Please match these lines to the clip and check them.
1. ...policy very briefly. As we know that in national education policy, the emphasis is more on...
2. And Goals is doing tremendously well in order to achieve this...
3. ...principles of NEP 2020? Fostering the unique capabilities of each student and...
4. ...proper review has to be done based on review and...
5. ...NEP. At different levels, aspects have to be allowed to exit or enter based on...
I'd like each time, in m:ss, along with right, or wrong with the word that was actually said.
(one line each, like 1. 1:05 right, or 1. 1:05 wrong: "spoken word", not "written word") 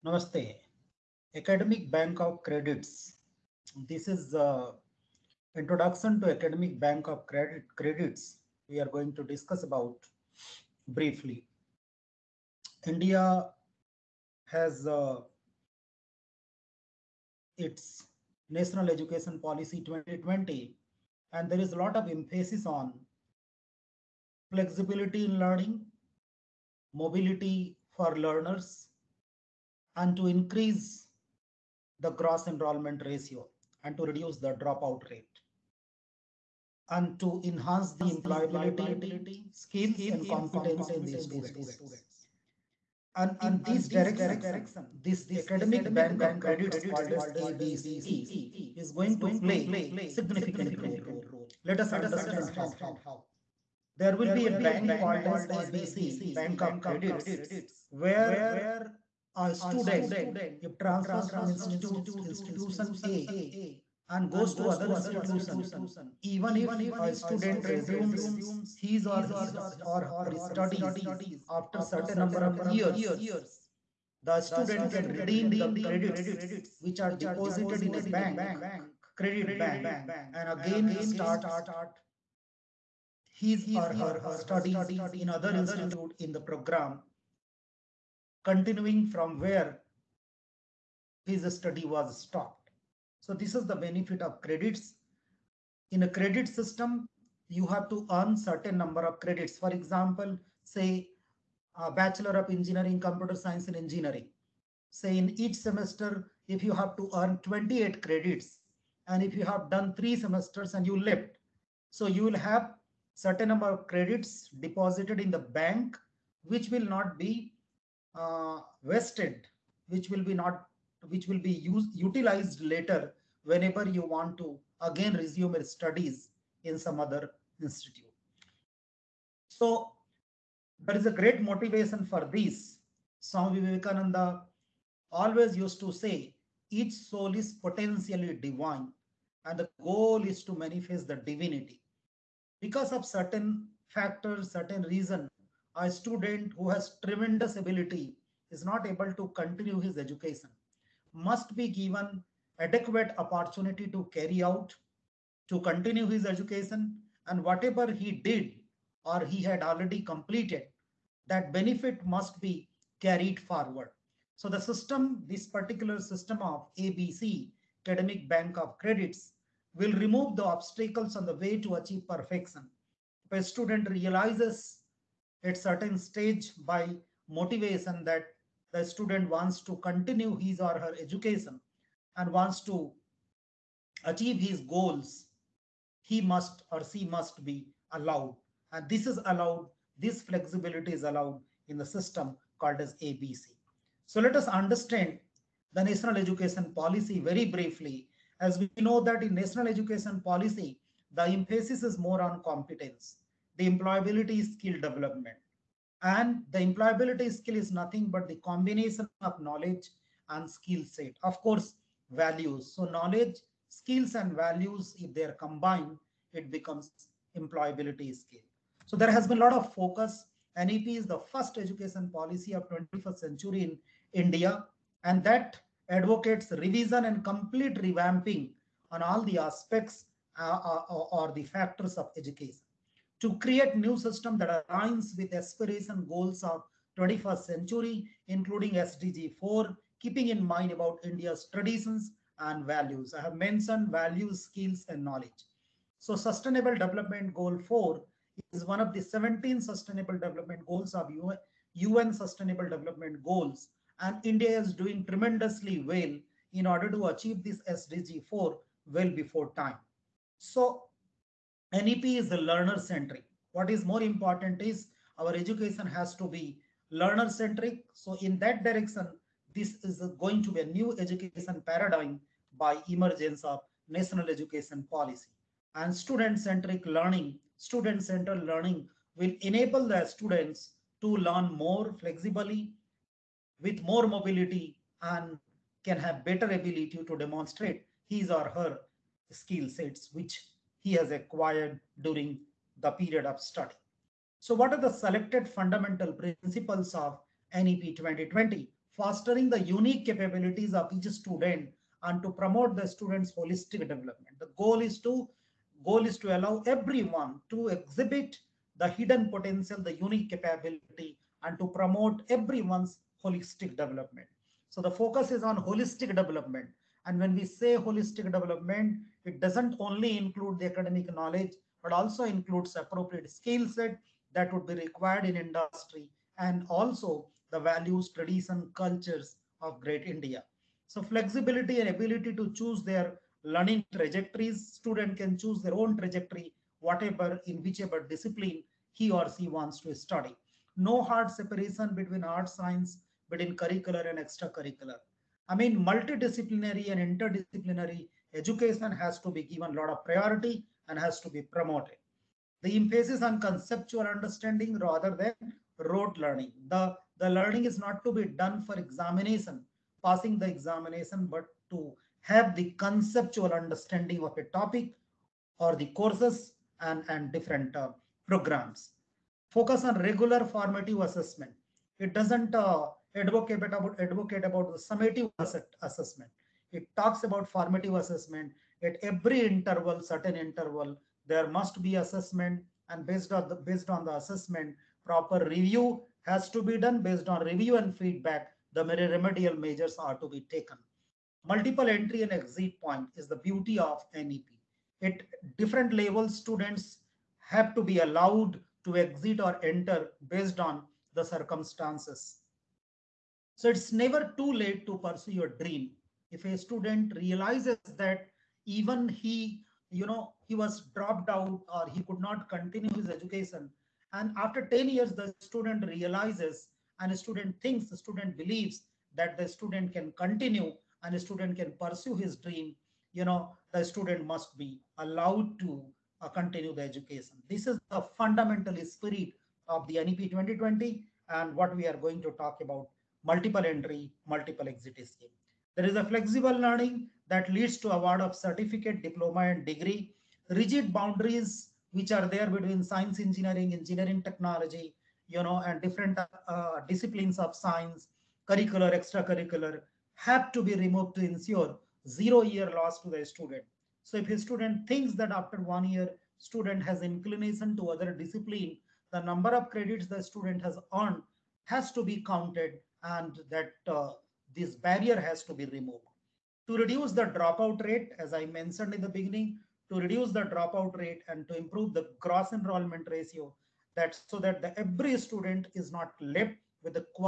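1. 3:16 right
2. 4:13 wrong: "India", not "Goals"
3. 4:56 right
4. 6:25 right
5. 6:34 wrong: "students", not "aspects".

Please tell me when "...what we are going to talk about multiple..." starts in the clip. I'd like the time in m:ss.
7:11.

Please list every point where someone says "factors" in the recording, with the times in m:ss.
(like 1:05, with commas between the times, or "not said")
2:23, 3:51.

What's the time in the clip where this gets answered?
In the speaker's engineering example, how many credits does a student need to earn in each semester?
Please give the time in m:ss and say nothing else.
1:47.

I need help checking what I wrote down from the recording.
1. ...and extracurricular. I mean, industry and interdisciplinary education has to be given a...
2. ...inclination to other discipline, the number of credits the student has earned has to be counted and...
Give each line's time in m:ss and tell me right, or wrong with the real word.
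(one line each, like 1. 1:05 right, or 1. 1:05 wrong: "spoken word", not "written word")
1. 5:44 wrong: "multidisciplinary", not "industry"
2. 7:37 right.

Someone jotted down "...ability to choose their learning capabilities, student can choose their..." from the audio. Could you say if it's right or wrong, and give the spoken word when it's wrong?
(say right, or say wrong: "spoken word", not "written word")
wrong: "trajectories", not "capabilities".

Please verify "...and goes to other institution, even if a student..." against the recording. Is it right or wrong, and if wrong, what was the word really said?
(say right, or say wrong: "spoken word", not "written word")
right.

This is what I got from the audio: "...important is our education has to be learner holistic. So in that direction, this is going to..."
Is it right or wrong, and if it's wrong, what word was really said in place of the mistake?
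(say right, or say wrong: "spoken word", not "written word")
wrong: "centric", not "holistic".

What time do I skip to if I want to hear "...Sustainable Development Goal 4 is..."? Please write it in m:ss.
4:06.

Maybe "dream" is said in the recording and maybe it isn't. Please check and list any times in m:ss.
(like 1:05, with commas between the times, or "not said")
6:45, 7:02.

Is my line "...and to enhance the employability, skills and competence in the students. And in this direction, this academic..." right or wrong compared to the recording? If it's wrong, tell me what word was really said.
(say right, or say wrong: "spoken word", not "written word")
right.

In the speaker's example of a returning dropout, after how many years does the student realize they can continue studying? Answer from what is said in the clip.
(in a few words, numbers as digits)
10 years.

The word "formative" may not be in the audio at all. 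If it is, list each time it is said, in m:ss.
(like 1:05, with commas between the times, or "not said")
6:10, 6:17.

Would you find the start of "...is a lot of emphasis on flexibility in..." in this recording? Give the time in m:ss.
0:21.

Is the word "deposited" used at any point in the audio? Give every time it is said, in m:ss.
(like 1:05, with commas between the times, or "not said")
1:17, 1:54.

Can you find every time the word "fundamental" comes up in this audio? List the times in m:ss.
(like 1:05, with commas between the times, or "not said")
4:55, 7:08.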